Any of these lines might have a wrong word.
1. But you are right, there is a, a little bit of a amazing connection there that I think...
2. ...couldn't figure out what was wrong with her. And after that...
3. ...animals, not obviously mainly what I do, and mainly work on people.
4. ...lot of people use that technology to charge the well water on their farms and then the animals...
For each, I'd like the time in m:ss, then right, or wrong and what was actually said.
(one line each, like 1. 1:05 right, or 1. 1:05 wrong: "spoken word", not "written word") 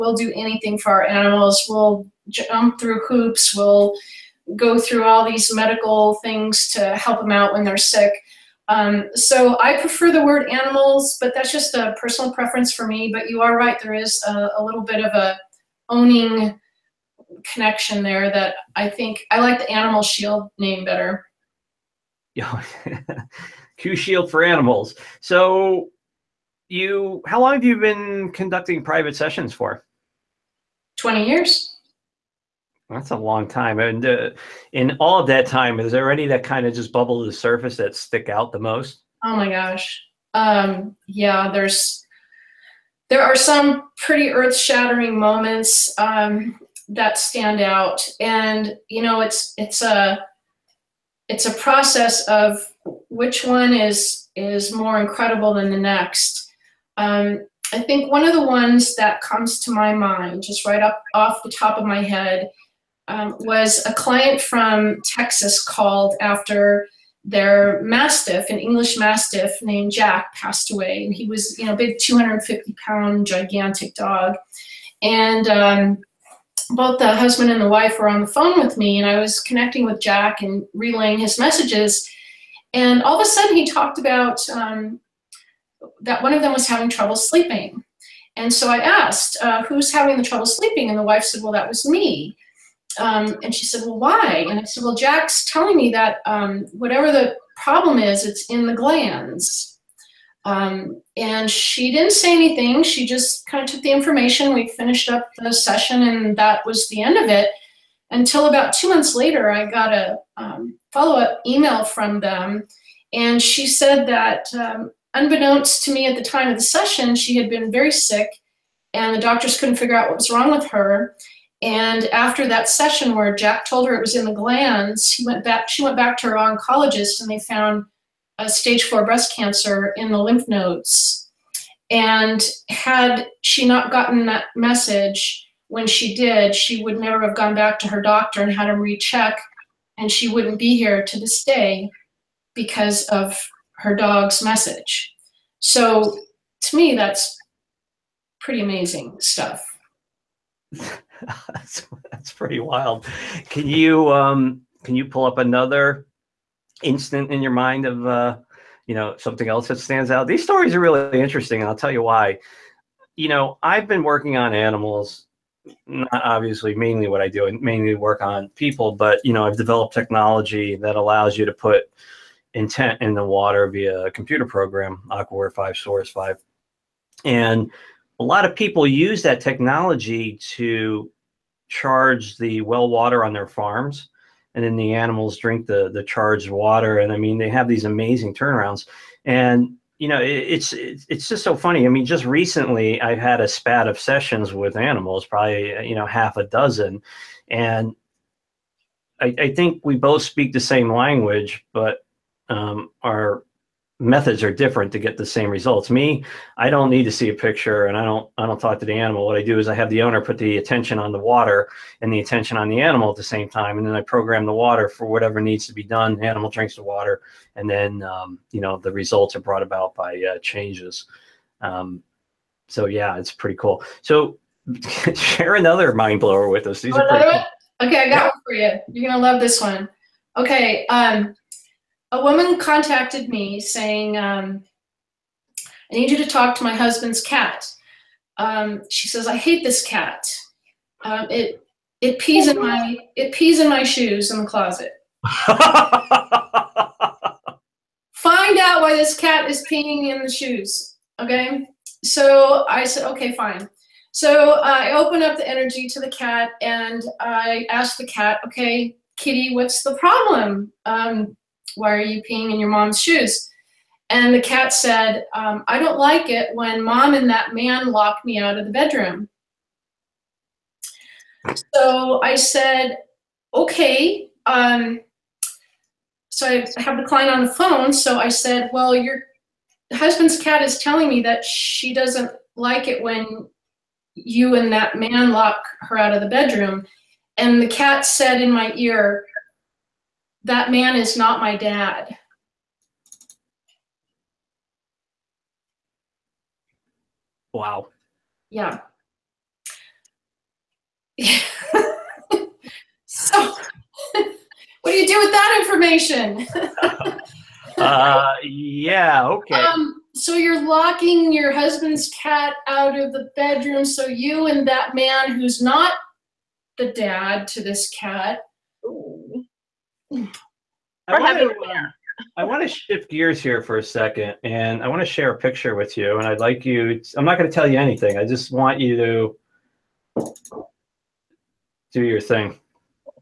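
1. 0:13 wrong: "owning", not "amazing"
2. 1:59 right
3. 2:44 right
4. 2:58 right.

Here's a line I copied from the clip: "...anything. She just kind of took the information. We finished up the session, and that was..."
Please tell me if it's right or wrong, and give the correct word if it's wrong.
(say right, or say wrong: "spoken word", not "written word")
right.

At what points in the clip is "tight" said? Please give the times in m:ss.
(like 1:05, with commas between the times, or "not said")
not said.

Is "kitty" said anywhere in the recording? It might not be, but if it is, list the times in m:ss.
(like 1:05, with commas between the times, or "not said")
4:19.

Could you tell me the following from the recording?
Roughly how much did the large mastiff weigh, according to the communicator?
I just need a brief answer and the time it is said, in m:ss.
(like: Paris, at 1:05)
250 pounds, at 1:11.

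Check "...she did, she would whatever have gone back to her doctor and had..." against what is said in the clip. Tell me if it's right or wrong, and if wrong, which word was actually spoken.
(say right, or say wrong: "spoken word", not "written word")
wrong: "never", not "whatever".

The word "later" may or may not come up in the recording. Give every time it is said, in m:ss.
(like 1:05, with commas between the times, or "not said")
1:49.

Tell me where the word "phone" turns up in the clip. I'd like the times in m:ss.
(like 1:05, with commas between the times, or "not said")
1:18, 4:37.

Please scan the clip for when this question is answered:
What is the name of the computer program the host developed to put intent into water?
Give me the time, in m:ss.
2:55.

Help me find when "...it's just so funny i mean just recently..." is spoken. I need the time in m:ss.
3:10.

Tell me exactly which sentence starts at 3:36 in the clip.
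The animal drinks the water and then um, you know the results are brought about by uh, changes.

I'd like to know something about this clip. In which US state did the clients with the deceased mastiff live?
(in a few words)
Texas.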